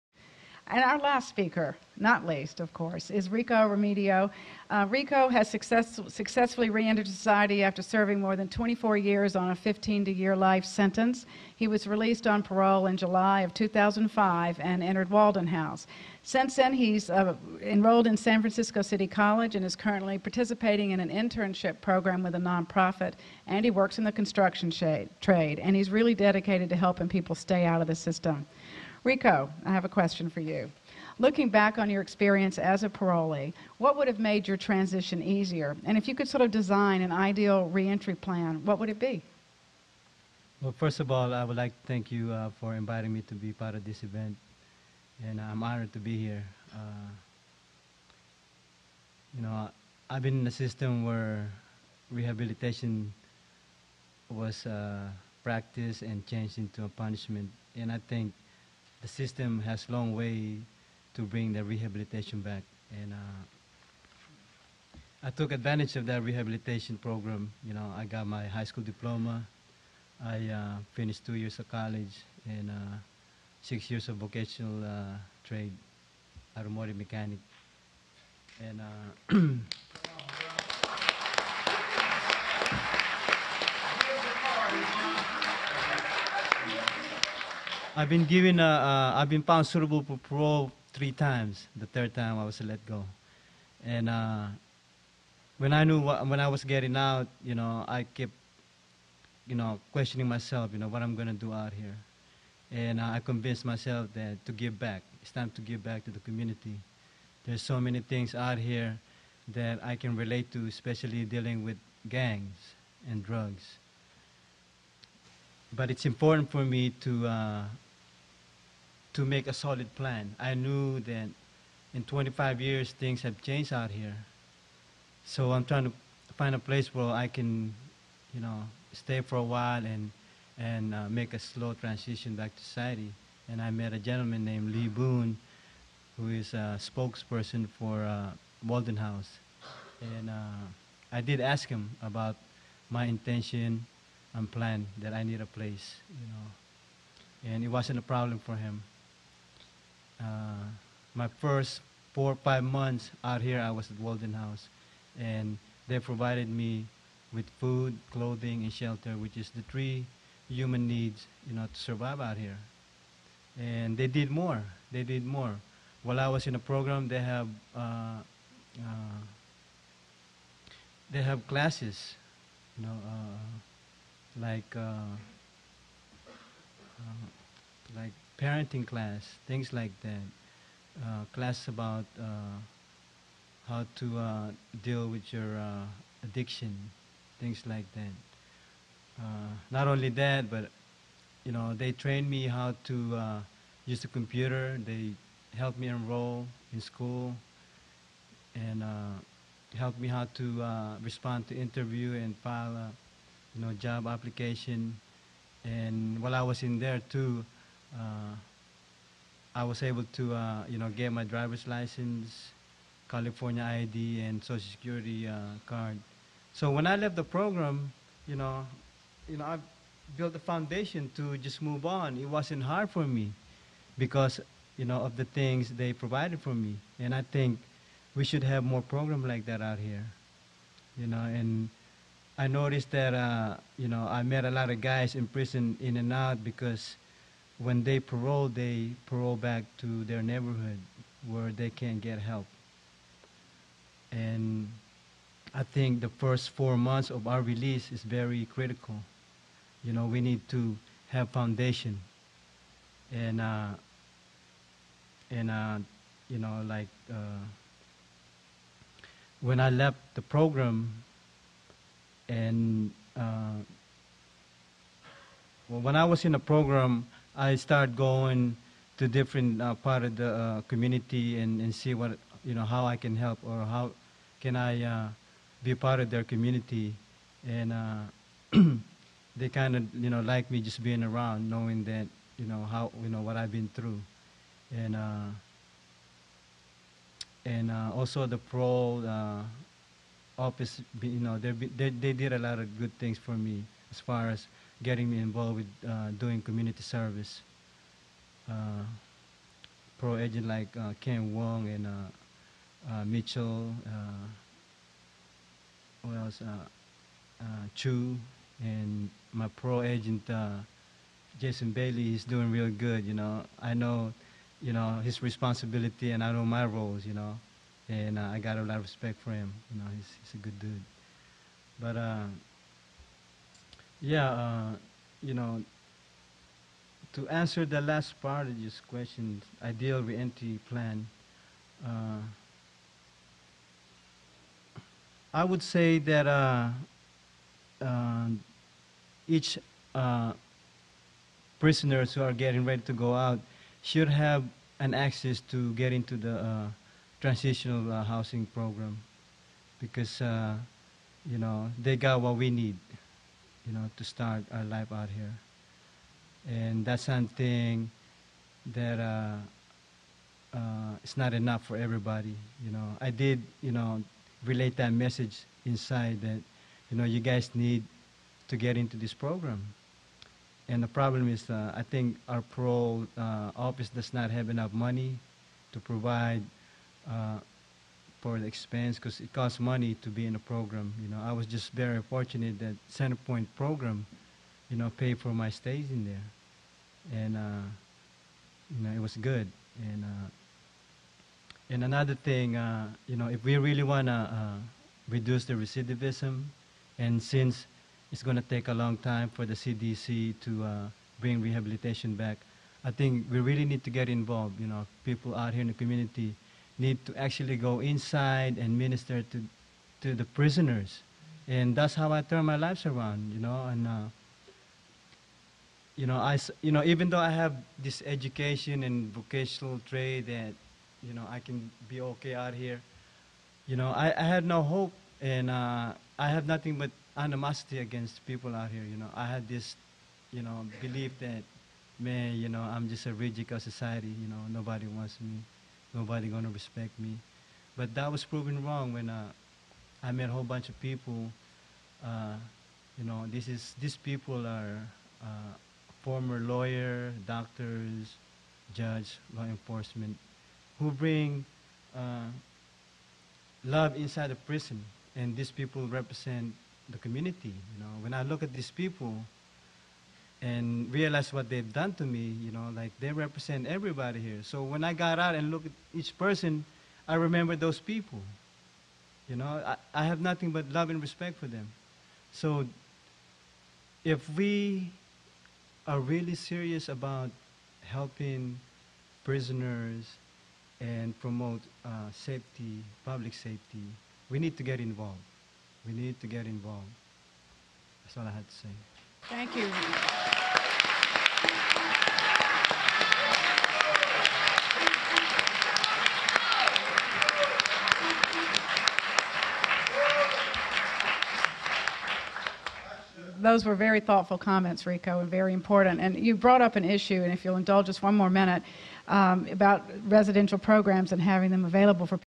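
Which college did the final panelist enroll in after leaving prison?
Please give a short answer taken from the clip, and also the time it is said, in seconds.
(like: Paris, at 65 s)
San Francisco City College, at 18 s.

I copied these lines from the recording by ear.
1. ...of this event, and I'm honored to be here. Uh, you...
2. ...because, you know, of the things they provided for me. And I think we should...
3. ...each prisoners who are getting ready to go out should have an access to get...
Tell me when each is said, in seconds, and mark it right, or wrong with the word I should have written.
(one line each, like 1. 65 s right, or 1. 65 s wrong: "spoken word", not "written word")
1. 43 s right
2. 223 s right
3. 339 s right.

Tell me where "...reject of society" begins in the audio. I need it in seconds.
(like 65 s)
433 s.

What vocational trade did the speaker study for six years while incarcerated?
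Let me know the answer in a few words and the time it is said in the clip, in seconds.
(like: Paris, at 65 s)
Automotive mechanic, at 76 s.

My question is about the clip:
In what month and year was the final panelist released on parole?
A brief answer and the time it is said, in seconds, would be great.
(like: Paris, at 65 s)
July 2005, at 12 s.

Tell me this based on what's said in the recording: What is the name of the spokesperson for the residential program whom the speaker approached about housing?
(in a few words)
Lee Boone.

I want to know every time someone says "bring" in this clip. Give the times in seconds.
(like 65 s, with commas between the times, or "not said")
61 s, 401 s, 450 s.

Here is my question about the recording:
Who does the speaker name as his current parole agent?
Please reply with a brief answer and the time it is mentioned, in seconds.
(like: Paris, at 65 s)
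Jason Bailey, at 311 s.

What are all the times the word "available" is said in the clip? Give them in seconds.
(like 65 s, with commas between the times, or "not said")
511 s.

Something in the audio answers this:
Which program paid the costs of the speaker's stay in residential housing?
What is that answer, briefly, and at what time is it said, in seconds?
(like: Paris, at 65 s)
Centerpoint, at 382 s.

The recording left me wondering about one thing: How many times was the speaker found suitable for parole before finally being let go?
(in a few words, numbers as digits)
3.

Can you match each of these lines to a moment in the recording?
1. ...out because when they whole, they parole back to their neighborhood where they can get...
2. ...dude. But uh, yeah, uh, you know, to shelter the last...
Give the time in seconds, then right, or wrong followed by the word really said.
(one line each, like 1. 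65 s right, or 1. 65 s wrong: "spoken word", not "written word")
1. 236 s wrong: "parole", not "whole"
2. 320 s wrong: "answer", not "shelter".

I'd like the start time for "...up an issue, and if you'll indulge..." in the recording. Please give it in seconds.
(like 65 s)
506 s.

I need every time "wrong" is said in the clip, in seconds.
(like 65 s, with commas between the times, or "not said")
438 s.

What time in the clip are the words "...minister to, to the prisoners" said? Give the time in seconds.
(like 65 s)
408 s.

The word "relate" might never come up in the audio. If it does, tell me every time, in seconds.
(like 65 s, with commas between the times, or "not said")
110 s, 364 s.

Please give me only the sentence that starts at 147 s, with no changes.
And it wasn't a problem for him.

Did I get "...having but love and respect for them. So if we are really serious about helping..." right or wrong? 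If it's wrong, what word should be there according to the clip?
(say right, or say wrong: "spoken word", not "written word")
wrong: "nothing", not "having".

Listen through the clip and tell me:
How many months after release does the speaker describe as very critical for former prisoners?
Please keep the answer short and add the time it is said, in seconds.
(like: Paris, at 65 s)
4, at 246 s.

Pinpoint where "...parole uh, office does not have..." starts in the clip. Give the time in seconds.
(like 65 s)
372 s.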